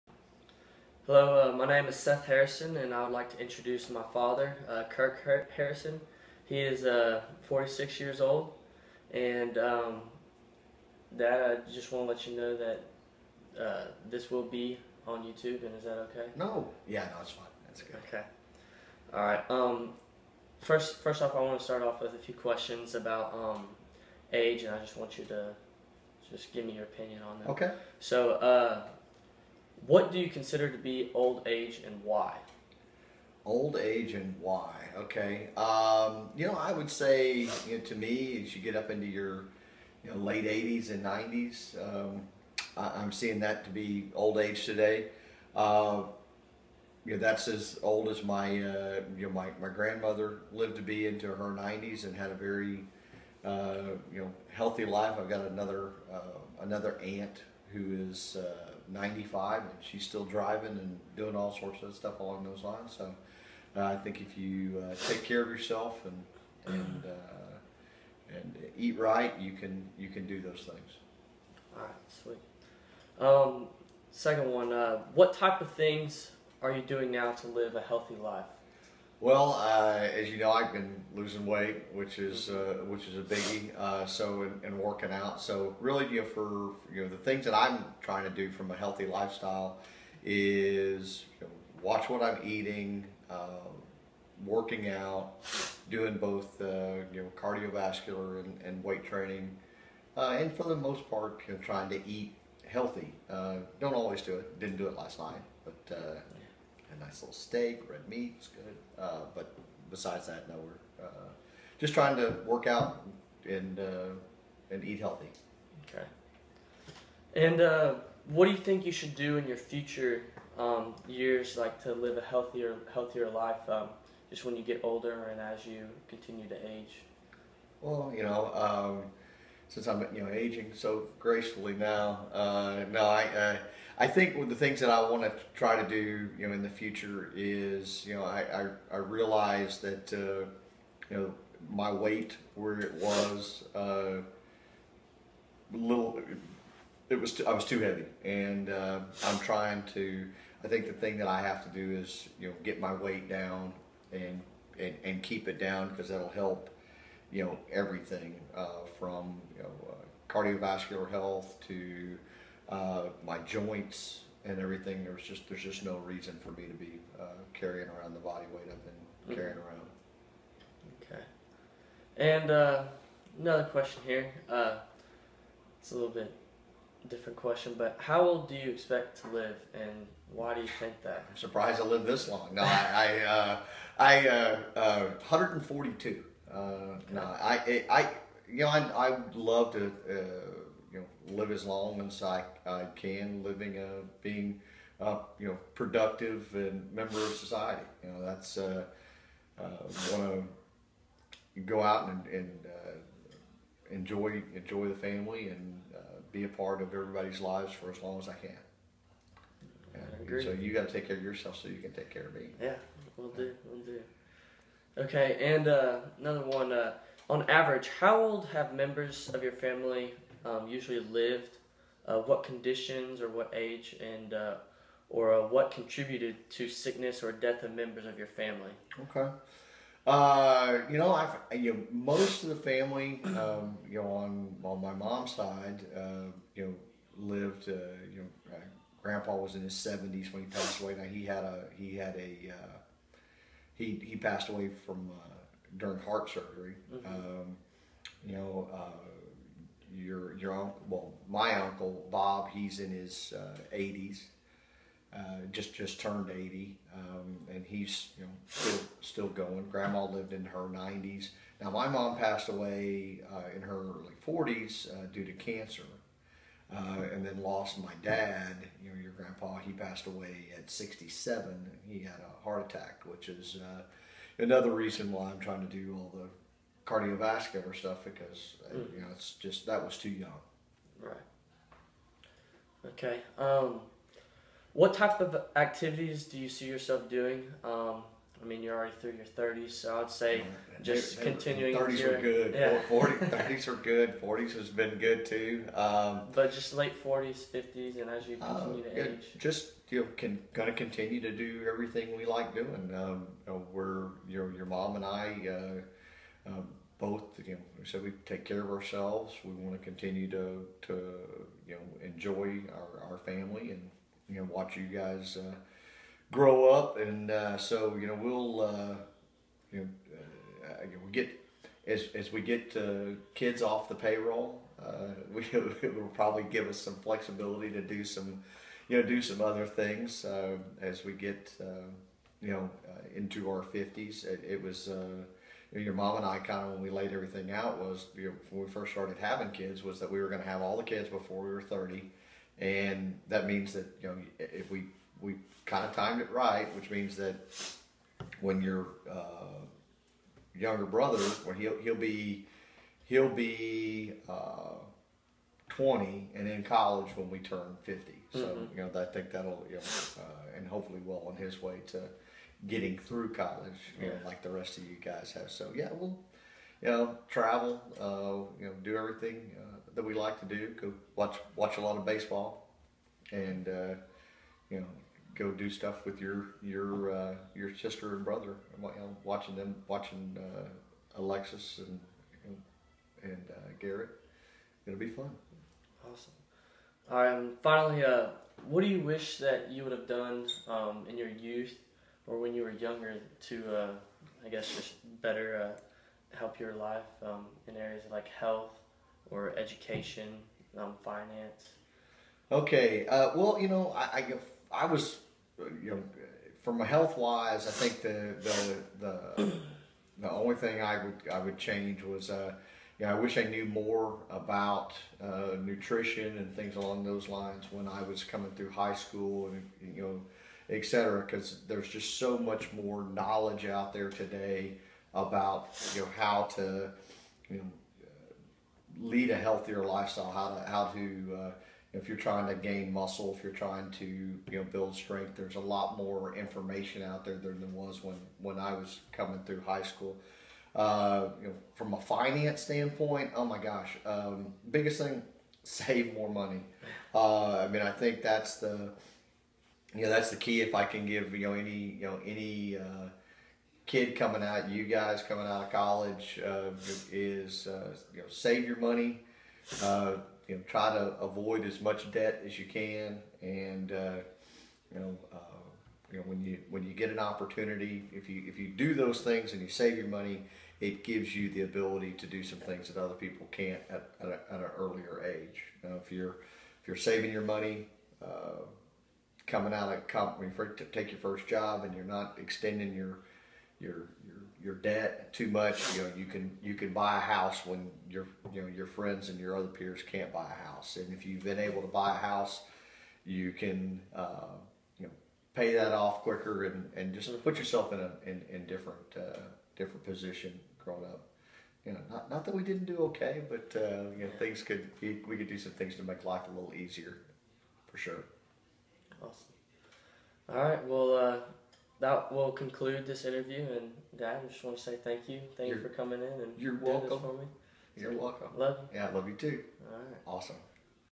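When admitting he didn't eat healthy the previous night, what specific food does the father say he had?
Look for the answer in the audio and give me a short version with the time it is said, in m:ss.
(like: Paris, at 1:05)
Steak, at 1:47.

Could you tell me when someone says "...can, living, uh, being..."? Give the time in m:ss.
3:12.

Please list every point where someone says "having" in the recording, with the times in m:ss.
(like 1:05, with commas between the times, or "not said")
5:39.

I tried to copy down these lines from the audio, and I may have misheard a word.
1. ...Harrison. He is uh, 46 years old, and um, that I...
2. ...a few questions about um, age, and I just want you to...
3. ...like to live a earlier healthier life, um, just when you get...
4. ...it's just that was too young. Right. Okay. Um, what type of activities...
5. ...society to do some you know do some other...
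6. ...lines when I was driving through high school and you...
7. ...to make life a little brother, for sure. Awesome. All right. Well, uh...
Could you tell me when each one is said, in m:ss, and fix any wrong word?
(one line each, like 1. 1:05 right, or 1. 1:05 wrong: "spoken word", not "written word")
1. 0:05 right
2. 0:22 right
3. 2:01 wrong: "healthier", not "earlier"
4. 4:39 right
5. 5:26 wrong: "flexibility", not "society"
6. 6:57 wrong: "coming", not "driving"
7. 8:25 wrong: "easier", not "brother".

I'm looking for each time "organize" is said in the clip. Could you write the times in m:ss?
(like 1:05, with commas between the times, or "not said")
not said.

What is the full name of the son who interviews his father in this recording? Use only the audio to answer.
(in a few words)
Seth Harrison.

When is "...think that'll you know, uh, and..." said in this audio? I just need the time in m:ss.
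5:59.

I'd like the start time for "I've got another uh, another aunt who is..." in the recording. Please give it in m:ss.
0:55.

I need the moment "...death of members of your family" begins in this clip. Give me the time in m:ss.
3:47.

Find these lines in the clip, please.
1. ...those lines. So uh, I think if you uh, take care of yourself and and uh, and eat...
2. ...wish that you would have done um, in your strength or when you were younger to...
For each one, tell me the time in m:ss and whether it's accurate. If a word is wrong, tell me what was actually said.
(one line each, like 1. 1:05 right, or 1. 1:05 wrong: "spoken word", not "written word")
1. 1:02 right
2. 6:29 wrong: "youth", not "strength".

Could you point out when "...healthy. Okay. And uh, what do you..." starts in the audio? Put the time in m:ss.
1:54.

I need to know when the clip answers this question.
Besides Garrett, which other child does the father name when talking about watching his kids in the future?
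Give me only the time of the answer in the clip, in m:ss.
6:21.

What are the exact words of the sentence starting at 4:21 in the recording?
Now my mom passed away uh, in her early forties uh, due to cancer uh, and then lost my dad.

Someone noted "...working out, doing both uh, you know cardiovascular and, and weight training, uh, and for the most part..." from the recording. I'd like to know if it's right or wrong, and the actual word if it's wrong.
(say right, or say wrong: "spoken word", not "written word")
right.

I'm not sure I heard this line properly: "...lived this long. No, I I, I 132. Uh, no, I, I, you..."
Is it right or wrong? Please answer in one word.
wrong.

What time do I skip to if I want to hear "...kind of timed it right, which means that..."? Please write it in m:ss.
5:45.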